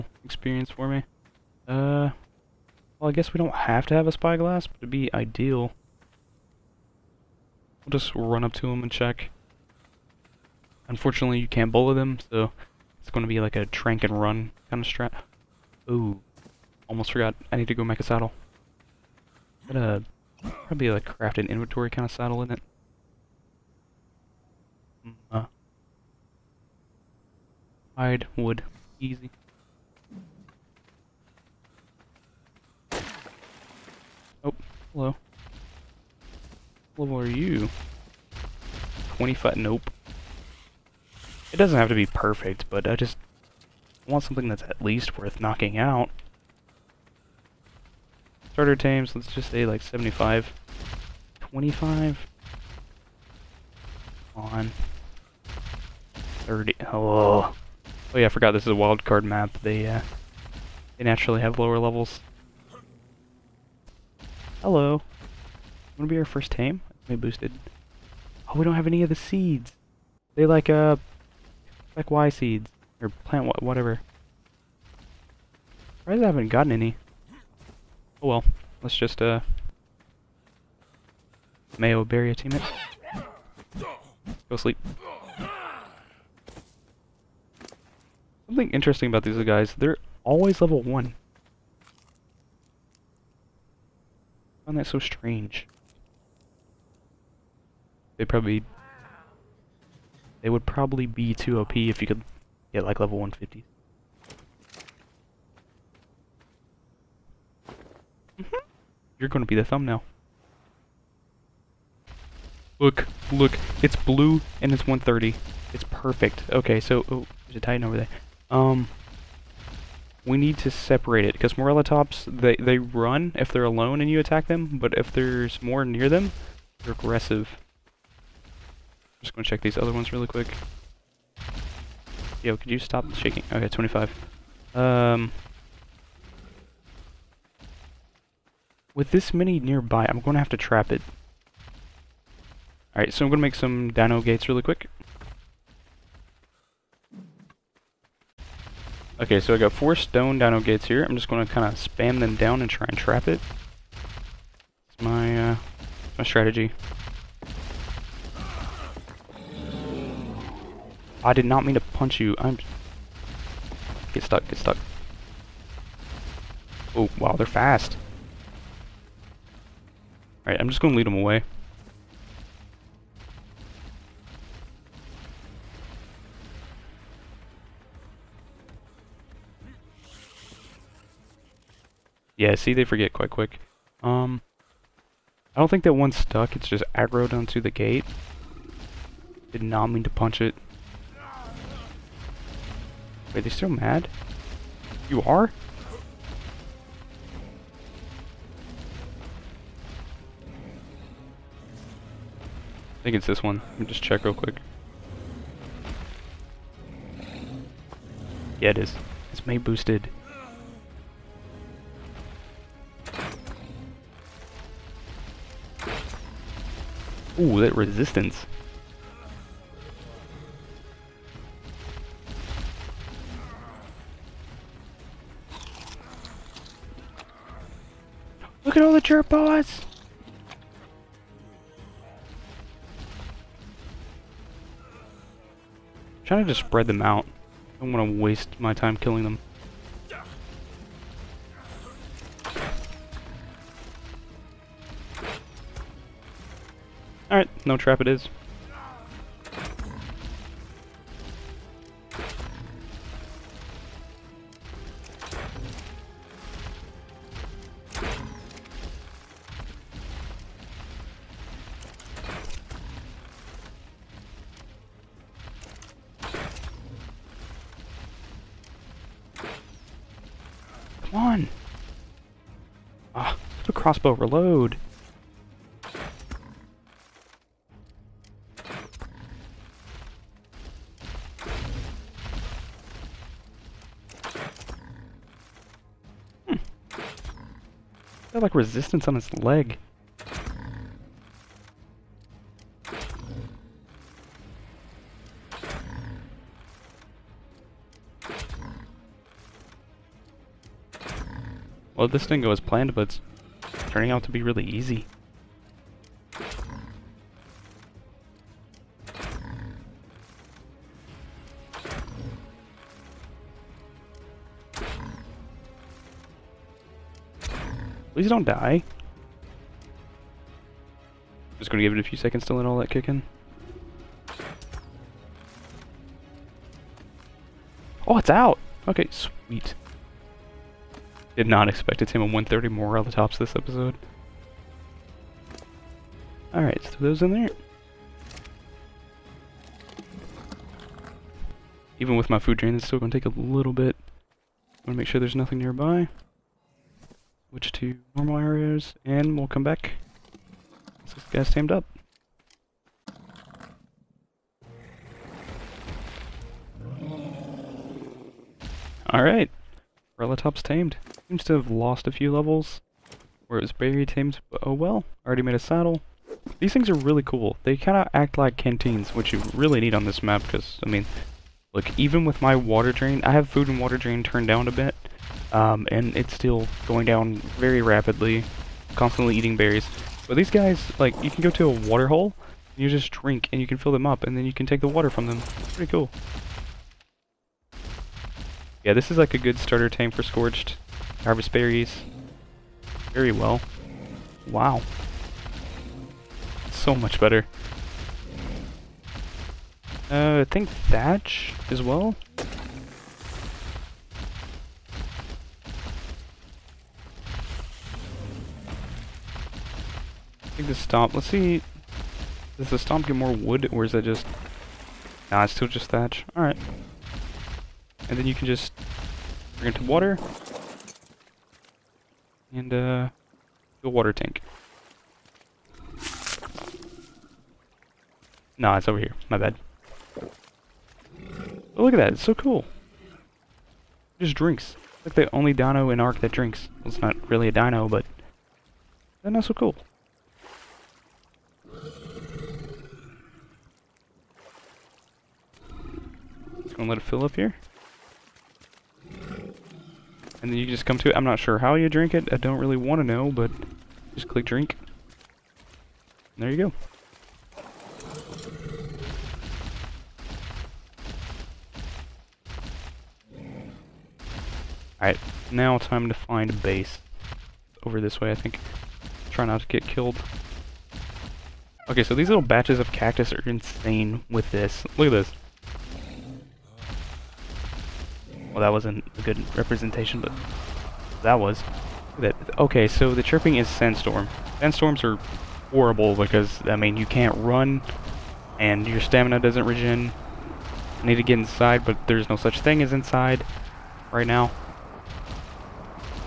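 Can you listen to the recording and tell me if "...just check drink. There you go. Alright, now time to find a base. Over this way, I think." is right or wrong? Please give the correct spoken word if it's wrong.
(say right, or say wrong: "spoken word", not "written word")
wrong: "click", not "check".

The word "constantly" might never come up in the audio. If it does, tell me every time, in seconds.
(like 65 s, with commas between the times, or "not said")
378 s.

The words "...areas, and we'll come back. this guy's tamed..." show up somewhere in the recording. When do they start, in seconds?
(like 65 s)
348 s.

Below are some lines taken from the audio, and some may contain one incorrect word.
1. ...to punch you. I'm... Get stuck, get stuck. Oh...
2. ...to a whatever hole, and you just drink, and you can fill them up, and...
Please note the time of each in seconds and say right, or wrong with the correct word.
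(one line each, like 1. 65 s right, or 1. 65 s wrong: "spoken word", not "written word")
1. 161 s right
2. 381 s wrong: "water", not "whatever".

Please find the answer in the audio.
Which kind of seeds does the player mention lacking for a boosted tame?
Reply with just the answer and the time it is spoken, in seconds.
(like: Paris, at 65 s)
Y seeds, at 72 s.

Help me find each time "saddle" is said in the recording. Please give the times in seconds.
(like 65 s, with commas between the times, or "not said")
18 s, 22 s, 365 s.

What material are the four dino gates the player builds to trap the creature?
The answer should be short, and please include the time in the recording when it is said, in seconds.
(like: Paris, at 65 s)
Stone, at 149 s.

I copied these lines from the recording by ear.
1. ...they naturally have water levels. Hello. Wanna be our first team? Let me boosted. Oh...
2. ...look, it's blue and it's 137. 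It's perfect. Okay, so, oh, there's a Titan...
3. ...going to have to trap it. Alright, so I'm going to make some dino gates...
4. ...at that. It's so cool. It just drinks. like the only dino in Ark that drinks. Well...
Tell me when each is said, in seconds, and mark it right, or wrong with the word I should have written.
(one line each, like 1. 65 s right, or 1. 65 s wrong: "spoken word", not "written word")
1. 60 s wrong: "lower", not "water"
2. 113 s wrong: "130", not "137"
3. 140 s right
4. 431 s right.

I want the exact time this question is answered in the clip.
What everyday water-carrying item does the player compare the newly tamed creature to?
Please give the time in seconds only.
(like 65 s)
368 s.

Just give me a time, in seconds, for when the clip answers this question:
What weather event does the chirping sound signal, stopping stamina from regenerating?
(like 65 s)
483 s.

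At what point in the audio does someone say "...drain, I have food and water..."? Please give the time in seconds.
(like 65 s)
372 s.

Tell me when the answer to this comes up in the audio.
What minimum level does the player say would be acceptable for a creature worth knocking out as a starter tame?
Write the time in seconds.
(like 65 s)
49 s.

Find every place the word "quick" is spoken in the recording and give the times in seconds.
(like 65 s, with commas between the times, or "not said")
130 s, 144 s, 183 s, 204 s.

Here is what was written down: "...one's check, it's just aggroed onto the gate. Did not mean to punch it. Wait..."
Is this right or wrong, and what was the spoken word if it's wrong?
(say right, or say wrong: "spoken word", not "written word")
wrong: "stuck", not "check".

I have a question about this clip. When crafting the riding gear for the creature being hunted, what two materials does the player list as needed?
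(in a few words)
Hide, wood.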